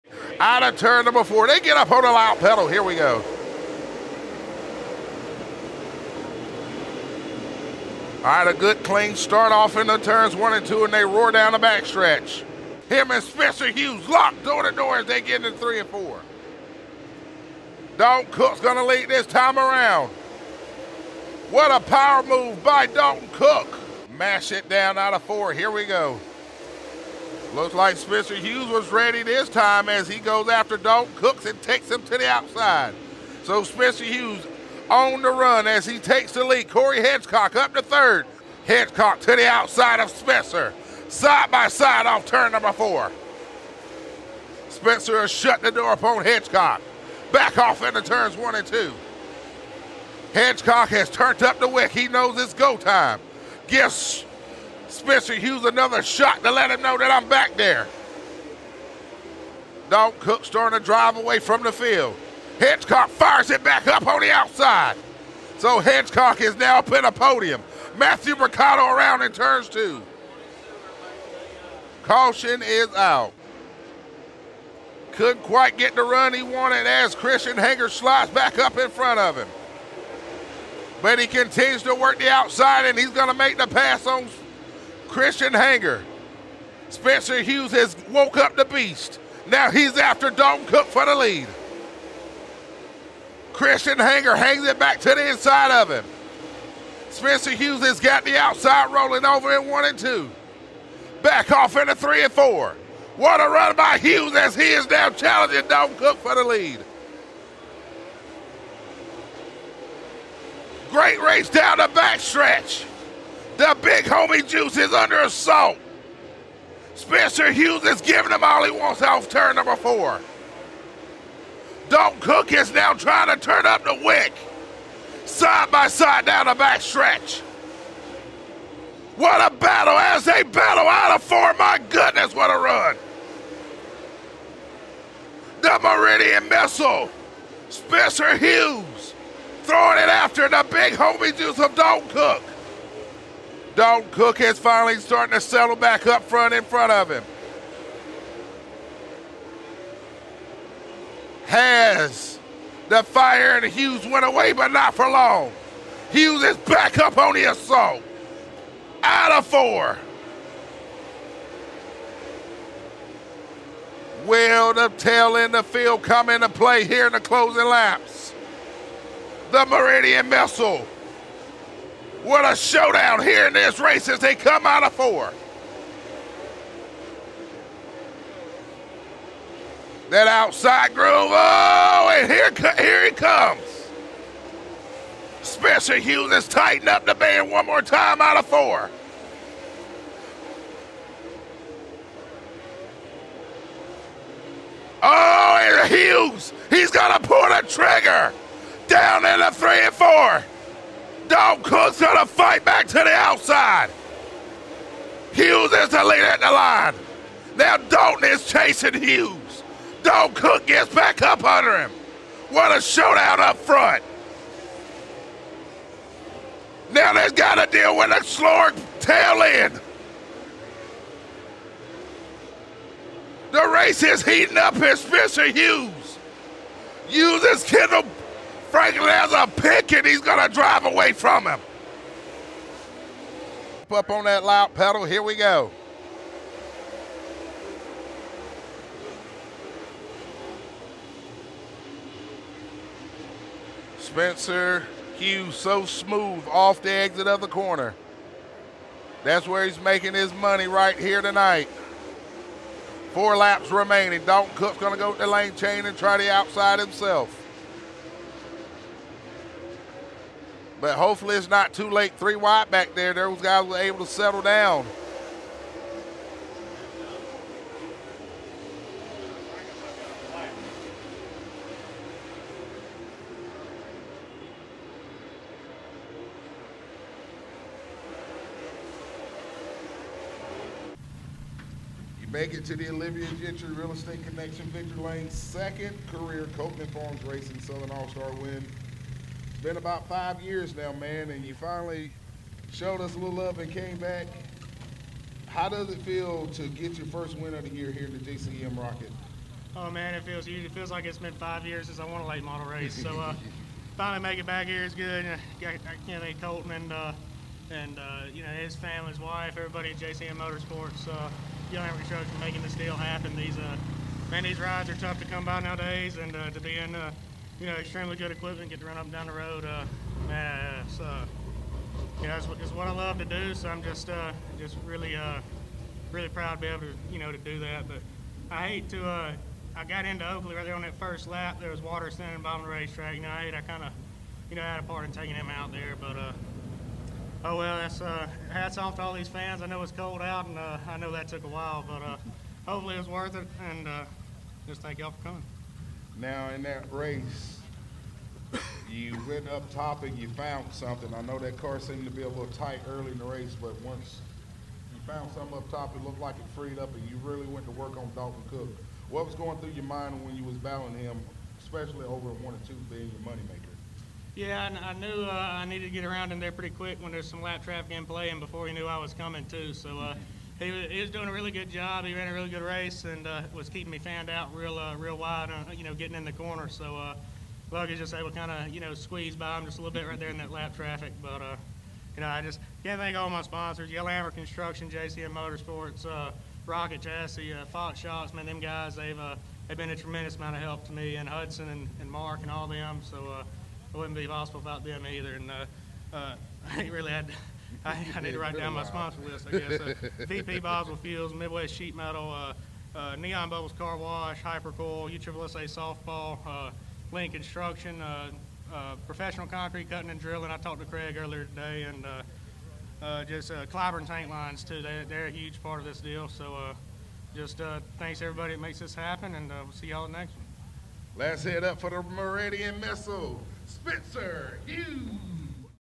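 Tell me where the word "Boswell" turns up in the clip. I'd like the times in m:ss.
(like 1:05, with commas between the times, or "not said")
6:40.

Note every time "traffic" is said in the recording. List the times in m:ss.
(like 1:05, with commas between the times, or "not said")
6:07, 6:20.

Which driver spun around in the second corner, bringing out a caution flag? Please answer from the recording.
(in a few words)
Matthew Mercado.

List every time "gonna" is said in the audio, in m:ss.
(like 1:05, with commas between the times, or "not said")
3:22, 3:50.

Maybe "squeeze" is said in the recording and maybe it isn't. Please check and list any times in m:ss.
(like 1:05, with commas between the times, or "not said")
6:18.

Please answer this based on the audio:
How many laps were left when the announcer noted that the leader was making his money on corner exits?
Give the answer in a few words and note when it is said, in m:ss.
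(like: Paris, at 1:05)
4, at 4:13.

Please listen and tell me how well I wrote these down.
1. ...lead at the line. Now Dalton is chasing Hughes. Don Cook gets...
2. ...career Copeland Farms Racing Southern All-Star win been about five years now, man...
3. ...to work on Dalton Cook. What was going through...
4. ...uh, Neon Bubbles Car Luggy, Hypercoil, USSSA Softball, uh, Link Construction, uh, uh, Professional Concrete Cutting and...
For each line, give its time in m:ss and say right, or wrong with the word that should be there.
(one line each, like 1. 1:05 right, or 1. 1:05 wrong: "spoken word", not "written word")
1. 3:26 right
2. 4:46 right
3. 5:57 right
4. 6:42 wrong: "Wash", not "Luggy".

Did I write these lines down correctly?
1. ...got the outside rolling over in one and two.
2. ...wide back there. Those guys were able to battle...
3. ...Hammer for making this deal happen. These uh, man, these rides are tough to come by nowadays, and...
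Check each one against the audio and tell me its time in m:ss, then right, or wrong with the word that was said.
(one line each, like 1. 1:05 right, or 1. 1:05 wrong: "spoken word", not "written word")
1. 1:37 right
2. 4:22 wrong: "settle", not "battle"
3. 5:11 right.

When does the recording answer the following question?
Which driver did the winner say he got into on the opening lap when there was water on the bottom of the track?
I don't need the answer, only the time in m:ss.
5:30.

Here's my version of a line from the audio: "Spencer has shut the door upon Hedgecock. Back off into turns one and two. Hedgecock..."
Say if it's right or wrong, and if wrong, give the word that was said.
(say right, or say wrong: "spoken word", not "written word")
right.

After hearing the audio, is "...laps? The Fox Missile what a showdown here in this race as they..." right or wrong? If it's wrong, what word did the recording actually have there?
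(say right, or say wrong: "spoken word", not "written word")
wrong: "Meridian", not "Fox".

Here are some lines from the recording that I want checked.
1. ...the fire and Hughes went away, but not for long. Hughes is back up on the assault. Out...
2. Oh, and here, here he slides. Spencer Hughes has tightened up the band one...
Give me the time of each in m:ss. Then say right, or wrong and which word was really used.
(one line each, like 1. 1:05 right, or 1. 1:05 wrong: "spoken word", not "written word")
1. 2:32 right
2. 3:01 wrong: "comes", not "slides".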